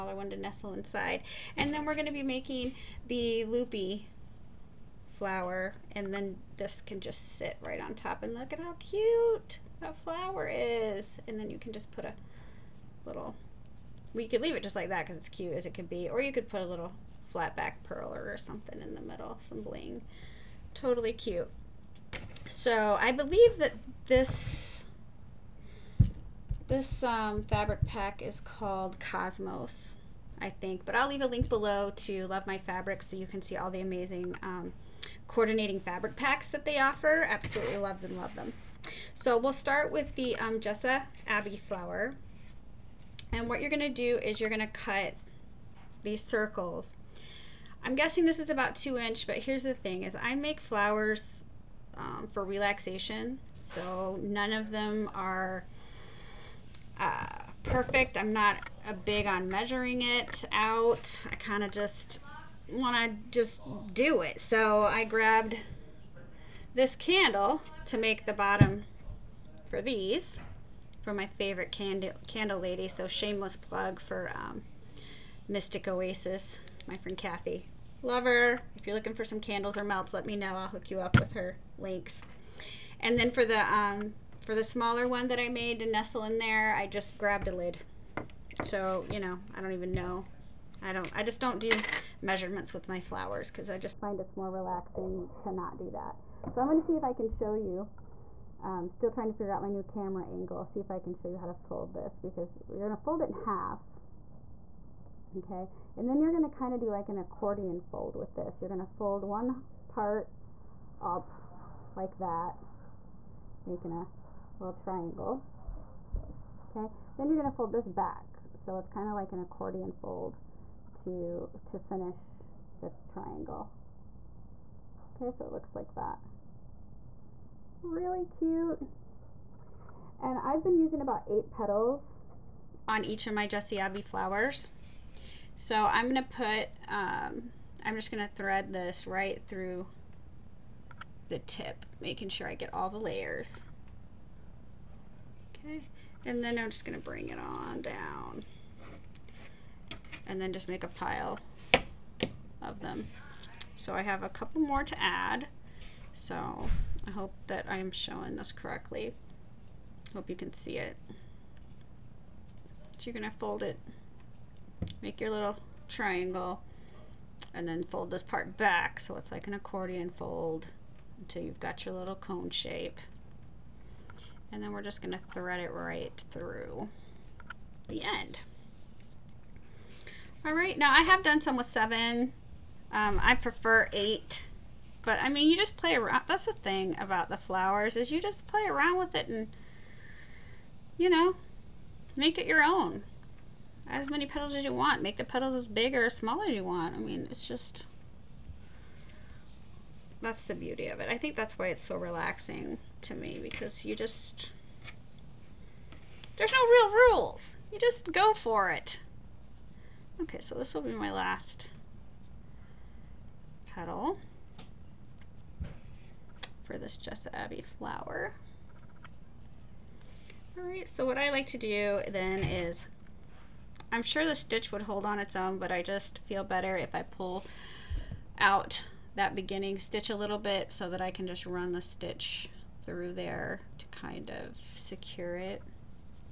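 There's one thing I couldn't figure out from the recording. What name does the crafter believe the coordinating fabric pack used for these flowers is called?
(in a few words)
Cosmos.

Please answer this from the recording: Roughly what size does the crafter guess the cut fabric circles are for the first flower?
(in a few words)
2 inch.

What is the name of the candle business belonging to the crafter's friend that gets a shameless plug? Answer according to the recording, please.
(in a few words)
Mystic Oasis.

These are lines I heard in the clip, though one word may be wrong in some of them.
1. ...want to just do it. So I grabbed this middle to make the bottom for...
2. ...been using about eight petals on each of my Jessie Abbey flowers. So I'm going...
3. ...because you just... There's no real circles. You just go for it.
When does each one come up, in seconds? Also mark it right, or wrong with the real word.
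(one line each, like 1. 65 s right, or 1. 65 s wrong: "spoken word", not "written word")
1. 62 s wrong: "candle", not "middle"
2. 130 s right
3. 203 s wrong: "rules", not "circles".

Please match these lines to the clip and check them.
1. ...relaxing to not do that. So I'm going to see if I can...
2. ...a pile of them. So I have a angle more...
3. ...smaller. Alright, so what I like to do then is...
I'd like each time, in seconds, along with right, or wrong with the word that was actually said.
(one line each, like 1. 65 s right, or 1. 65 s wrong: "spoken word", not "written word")
1. 94 s right
2. 150 s wrong: "couple", not "angle"
3. 217 s wrong: "flower", not "smaller".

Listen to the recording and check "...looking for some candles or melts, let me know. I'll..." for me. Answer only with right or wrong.
right.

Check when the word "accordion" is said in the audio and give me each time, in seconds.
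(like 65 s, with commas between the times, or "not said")
107 s, 119 s, 169 s.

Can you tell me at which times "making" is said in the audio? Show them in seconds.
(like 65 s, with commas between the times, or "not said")
2 s, 113 s, 142 s.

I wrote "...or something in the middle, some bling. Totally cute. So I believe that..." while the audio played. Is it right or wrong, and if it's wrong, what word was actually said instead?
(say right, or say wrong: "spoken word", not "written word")
right.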